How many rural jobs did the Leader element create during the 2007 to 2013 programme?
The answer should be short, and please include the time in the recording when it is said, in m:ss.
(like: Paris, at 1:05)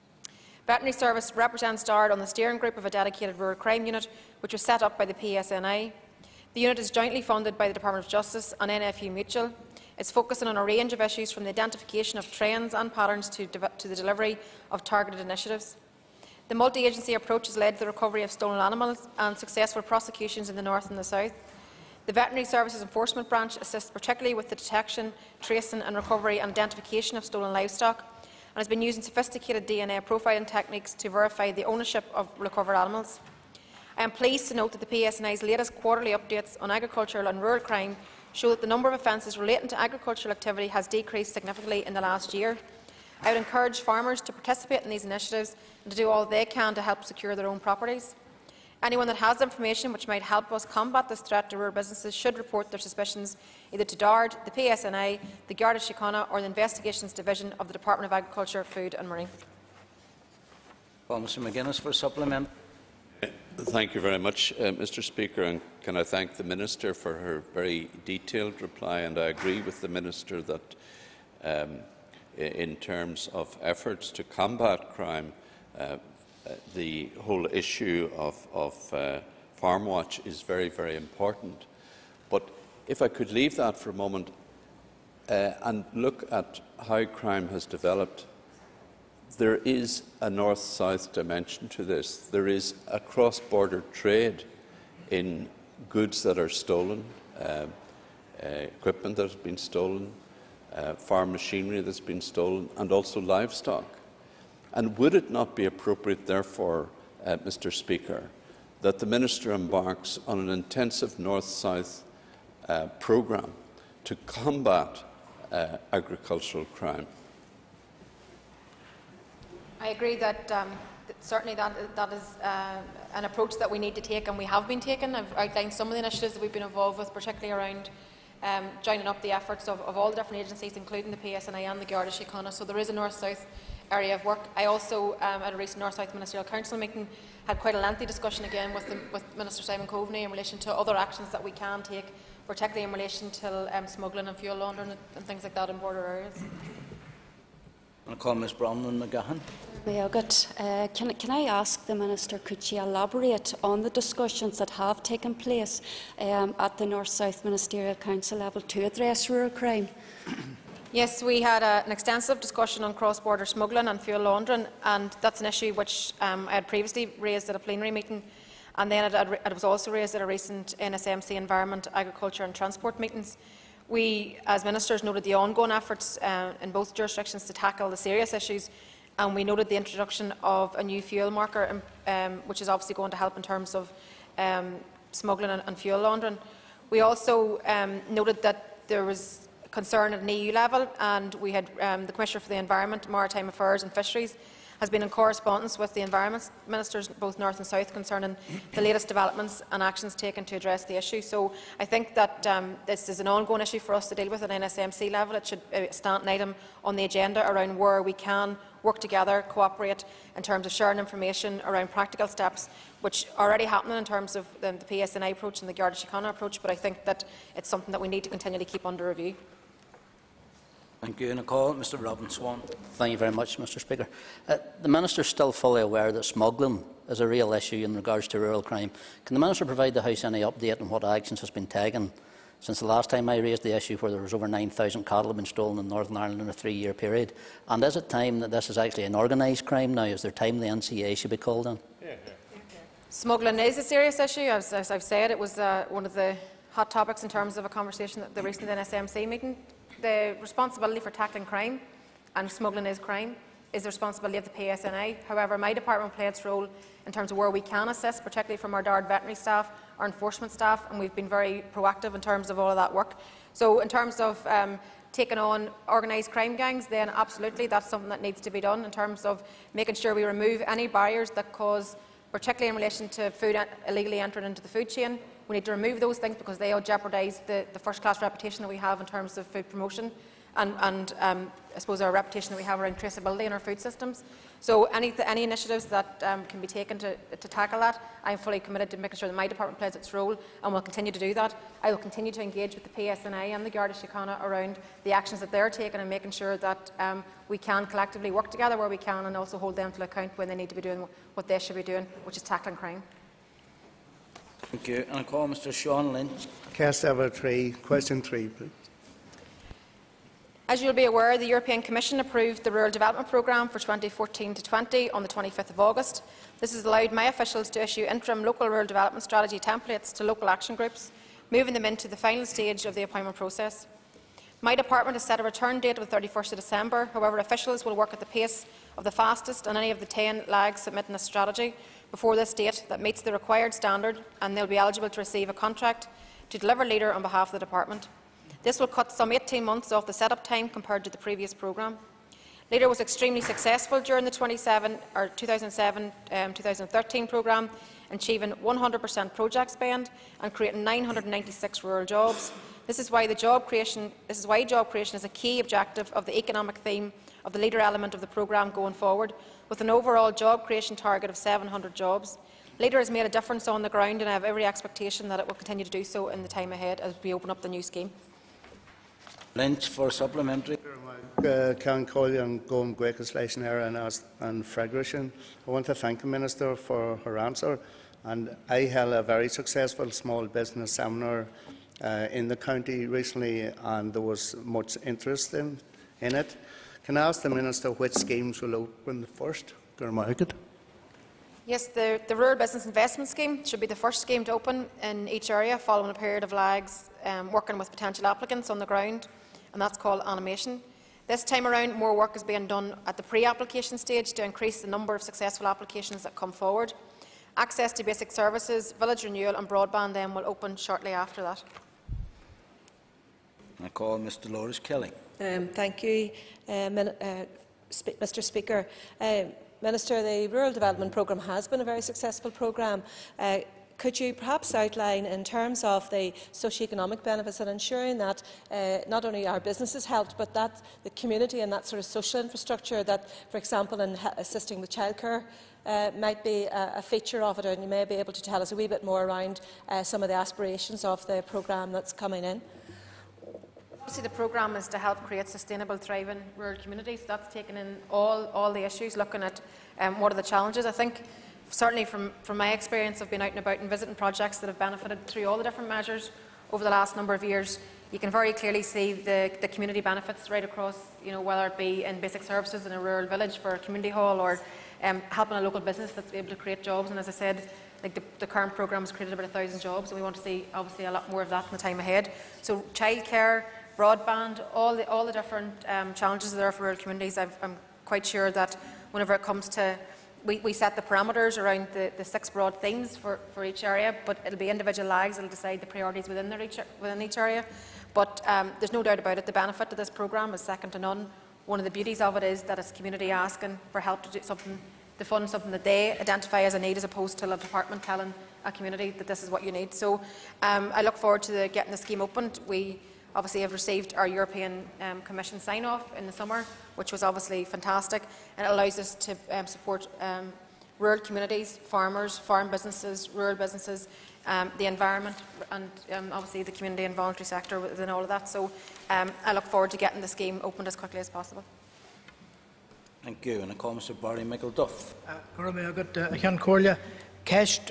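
996, at 5:50.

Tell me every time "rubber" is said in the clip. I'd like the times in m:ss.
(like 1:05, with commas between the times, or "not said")
not said.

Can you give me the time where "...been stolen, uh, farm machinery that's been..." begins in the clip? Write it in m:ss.
1:39.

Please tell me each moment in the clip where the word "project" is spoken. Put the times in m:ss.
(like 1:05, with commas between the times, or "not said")
5:49, 7:34.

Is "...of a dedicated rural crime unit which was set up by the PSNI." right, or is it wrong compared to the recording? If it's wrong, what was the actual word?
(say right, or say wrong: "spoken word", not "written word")
right.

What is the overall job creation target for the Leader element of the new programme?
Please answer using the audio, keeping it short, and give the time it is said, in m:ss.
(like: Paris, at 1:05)
700 jobs, at 6:01.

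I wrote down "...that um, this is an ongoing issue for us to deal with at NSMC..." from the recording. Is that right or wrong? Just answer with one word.
right.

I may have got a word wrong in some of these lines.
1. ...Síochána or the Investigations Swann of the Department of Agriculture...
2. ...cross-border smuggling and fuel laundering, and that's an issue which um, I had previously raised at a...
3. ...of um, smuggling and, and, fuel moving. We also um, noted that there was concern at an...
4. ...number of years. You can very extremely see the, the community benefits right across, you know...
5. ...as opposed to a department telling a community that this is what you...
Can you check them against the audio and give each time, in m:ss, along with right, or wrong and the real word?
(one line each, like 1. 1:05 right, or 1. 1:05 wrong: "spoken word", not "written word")
1. 0:55 wrong: "Division", not "Swann"
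2. 2:42 right
3. 3:03 wrong: "laundering", not "moving"
4. 7:37 wrong: "clearly", not "extremely"
5. 8:16 right.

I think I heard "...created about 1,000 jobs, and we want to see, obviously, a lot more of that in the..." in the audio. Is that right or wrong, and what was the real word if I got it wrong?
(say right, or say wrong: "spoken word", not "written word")
right.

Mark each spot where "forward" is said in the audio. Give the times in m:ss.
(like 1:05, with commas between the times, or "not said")
5:58, 6:46, 8:21, 8:39.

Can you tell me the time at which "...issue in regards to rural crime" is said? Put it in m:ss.
3:47.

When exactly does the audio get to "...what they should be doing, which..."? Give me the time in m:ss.
5:01.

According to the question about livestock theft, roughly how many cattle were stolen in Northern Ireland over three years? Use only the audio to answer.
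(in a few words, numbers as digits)
9,000.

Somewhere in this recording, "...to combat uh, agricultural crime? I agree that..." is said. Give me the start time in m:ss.
1:54.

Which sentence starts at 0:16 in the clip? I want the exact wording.
The multi-agency approach has led to the recovery of stolen animals and successful prosecutions in the north and the south.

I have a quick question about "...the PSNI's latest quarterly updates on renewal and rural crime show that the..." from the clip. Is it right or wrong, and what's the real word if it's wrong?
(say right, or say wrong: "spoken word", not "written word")
wrong: "agricultural", not "renewal".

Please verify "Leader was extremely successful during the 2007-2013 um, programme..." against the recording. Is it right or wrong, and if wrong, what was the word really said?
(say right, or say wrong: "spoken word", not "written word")
right.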